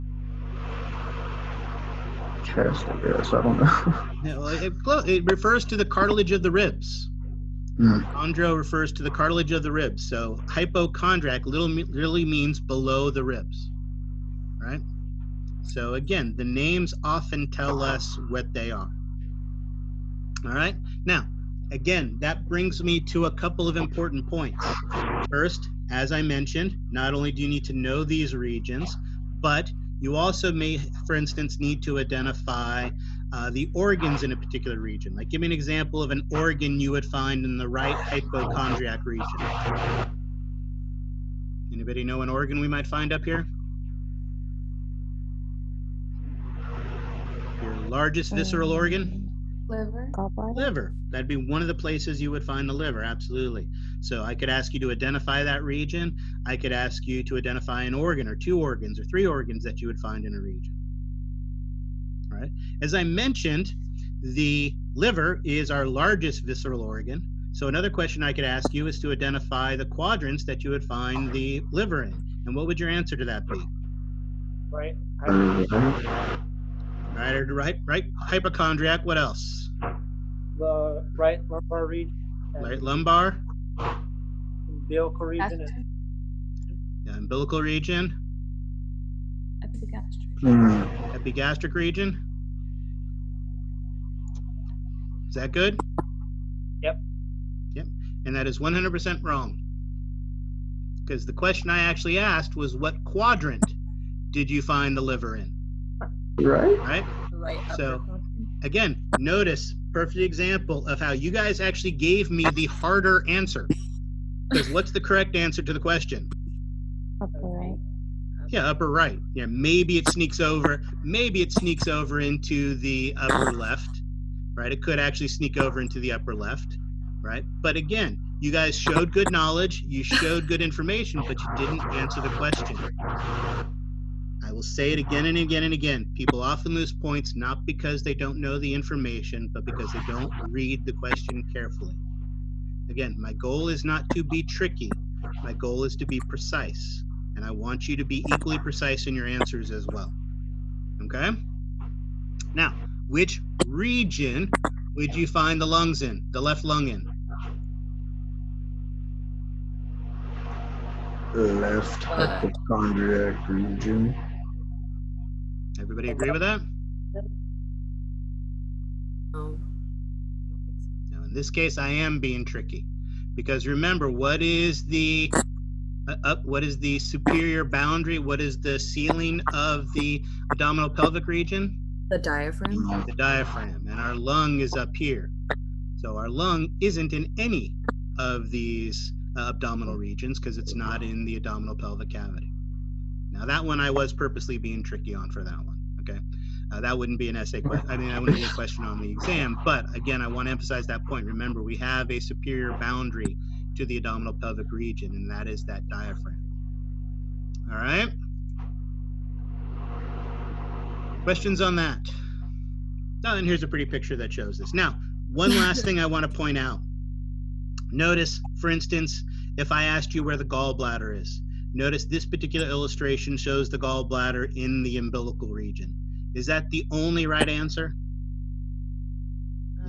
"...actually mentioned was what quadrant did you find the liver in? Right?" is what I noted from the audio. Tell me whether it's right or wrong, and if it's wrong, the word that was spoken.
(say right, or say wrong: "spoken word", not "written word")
wrong: "asked", not "mentioned".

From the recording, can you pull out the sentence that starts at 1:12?
And what would your answer to that be?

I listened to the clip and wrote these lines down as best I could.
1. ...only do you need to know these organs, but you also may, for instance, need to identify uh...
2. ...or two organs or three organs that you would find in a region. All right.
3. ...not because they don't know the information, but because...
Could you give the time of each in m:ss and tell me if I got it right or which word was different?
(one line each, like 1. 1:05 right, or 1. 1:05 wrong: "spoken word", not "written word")
1. 0:27 wrong: "regions", not "organs"
2. 0:58 right
3. 2:17 right.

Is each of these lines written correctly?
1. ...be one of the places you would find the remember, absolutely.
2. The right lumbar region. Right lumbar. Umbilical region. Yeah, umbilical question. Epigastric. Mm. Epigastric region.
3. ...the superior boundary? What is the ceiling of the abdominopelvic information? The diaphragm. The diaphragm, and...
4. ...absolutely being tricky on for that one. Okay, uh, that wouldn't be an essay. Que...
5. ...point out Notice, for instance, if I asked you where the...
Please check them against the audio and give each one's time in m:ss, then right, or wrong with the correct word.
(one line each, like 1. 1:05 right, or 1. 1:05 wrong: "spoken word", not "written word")
1. 0:51 wrong: "liver", not "remember"
2. 1:20 wrong: "region", not "question"
3. 2:56 wrong: "region", not "information"
4. 3:14 wrong: "purposely", not "absolutely"
5. 3:36 right.